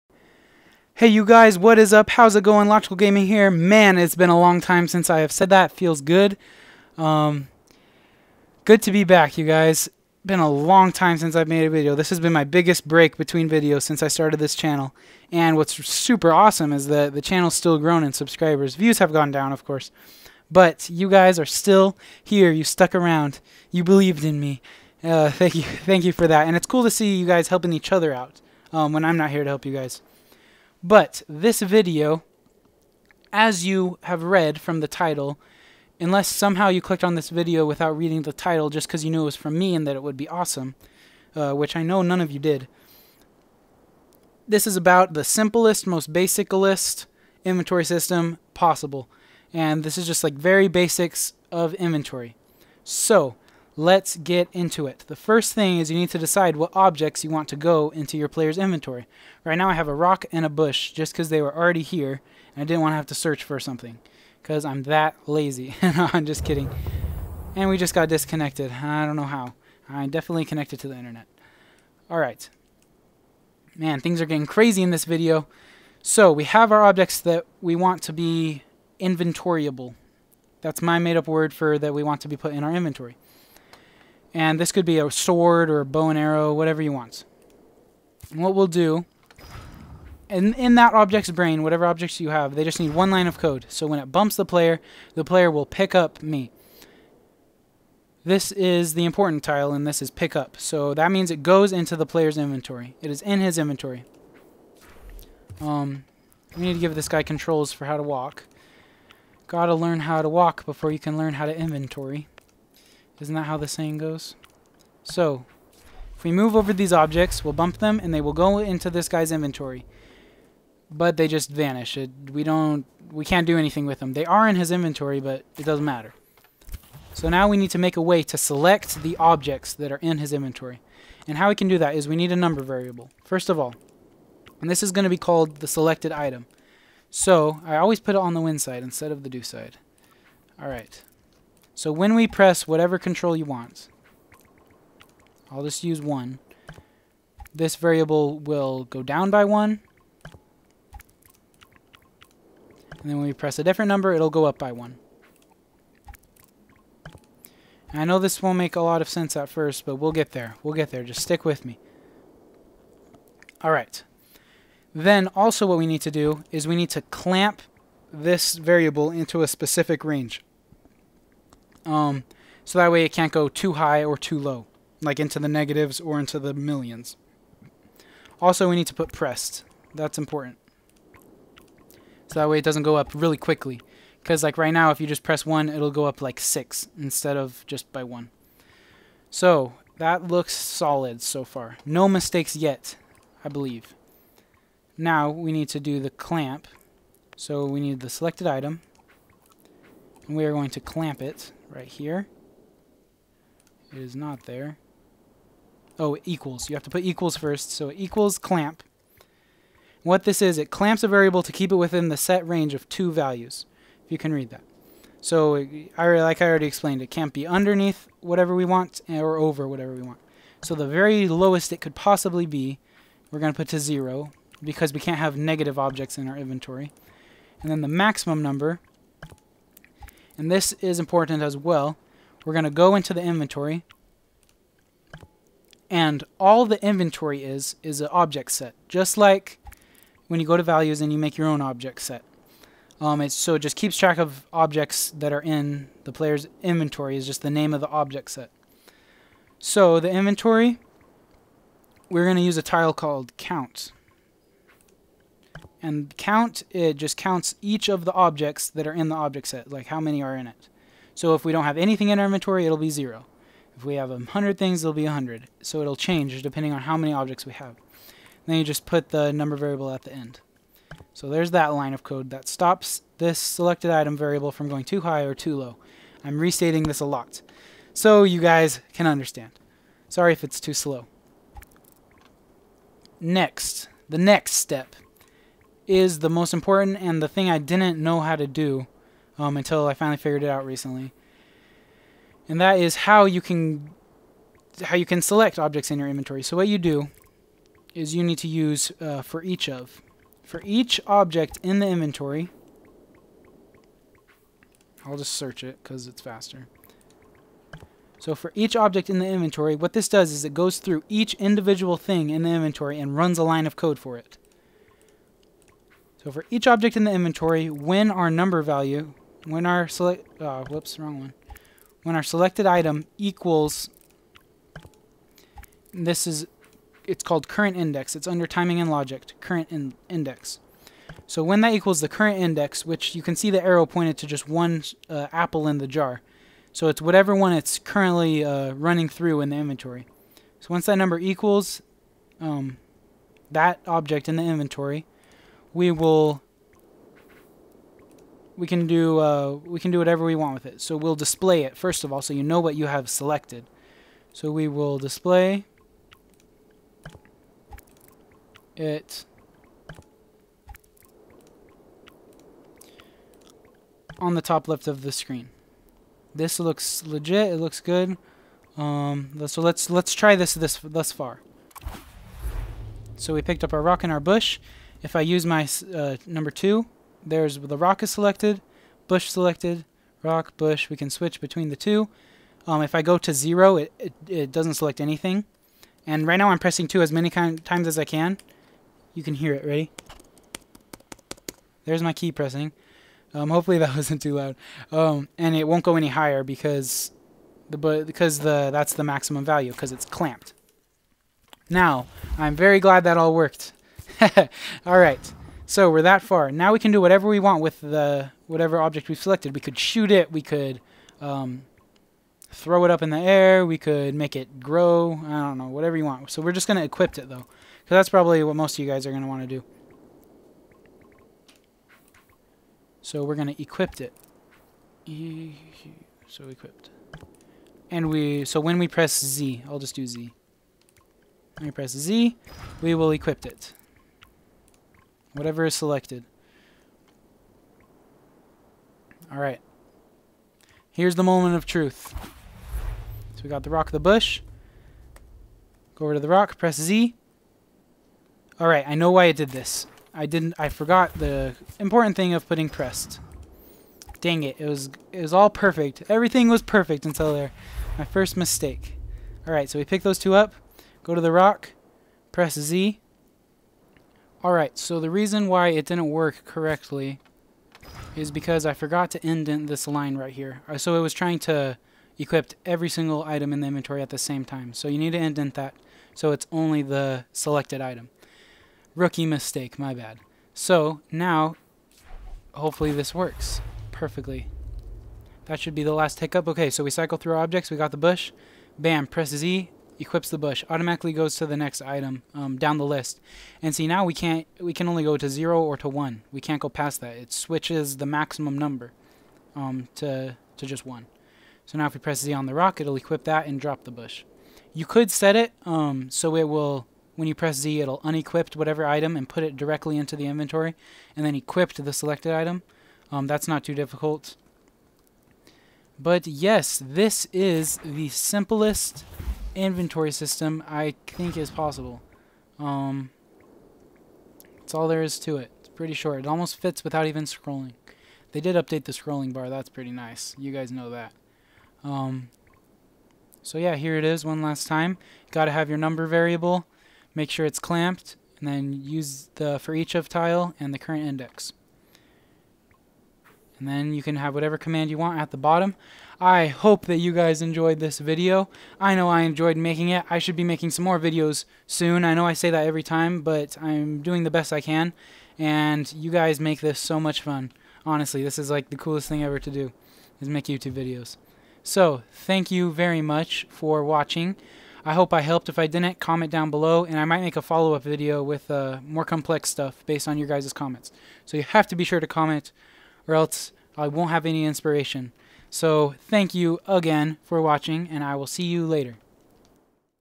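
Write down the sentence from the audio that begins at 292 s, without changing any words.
And that is how you can how you can select objects in your inventory.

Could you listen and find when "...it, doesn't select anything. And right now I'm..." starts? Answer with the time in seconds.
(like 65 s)
384 s.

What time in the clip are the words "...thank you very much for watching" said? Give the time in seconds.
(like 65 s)
562 s.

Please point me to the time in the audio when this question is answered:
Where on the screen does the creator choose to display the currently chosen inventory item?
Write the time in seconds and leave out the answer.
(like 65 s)
364 s.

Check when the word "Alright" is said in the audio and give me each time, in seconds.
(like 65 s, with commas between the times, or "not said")
72 s, 439 s, 448 s, 459 s, 464 s.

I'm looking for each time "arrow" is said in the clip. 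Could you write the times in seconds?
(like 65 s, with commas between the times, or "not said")
86 s, 333 s.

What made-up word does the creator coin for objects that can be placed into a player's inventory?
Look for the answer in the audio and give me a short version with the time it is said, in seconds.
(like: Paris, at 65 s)
Inventoryable, at 78 s.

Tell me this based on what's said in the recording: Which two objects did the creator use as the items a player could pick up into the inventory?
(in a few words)
A rock and a bush.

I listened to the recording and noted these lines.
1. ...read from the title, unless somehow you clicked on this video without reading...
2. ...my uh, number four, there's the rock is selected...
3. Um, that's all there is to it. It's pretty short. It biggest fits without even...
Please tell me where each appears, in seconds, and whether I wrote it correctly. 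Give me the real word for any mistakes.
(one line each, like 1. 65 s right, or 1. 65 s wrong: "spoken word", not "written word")
1. 34 s right
2. 375 s wrong: "two", not "four"
3. 522 s wrong: "almost", not "biggest".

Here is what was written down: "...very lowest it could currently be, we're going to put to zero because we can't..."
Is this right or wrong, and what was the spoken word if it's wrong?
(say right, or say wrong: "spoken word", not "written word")
wrong: "possibly", not "currently".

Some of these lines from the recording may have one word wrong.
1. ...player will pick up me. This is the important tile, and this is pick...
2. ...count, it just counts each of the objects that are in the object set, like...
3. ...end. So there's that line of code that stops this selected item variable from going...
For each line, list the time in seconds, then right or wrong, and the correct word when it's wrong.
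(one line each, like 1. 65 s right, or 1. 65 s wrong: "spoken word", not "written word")
1. 95 s right
2. 256 s right
3. 270 s right.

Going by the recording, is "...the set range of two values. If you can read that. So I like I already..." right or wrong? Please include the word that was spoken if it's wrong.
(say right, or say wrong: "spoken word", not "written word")
right.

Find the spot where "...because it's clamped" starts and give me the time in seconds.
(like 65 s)
399 s.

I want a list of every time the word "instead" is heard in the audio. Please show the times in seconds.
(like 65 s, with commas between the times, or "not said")
138 s, 186 s.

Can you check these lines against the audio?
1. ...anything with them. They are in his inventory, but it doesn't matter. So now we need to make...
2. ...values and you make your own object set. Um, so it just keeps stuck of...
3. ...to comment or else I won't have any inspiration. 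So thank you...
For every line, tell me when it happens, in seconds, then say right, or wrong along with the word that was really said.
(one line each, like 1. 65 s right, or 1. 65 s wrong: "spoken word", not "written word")
1. 123 s right
2. 240 s wrong: "track", not "stuck"
3. 571 s right.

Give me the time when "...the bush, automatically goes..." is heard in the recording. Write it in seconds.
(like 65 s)
490 s.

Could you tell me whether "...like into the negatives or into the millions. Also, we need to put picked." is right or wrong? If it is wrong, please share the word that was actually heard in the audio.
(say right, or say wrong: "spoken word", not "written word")
wrong: "pressed", not "picked".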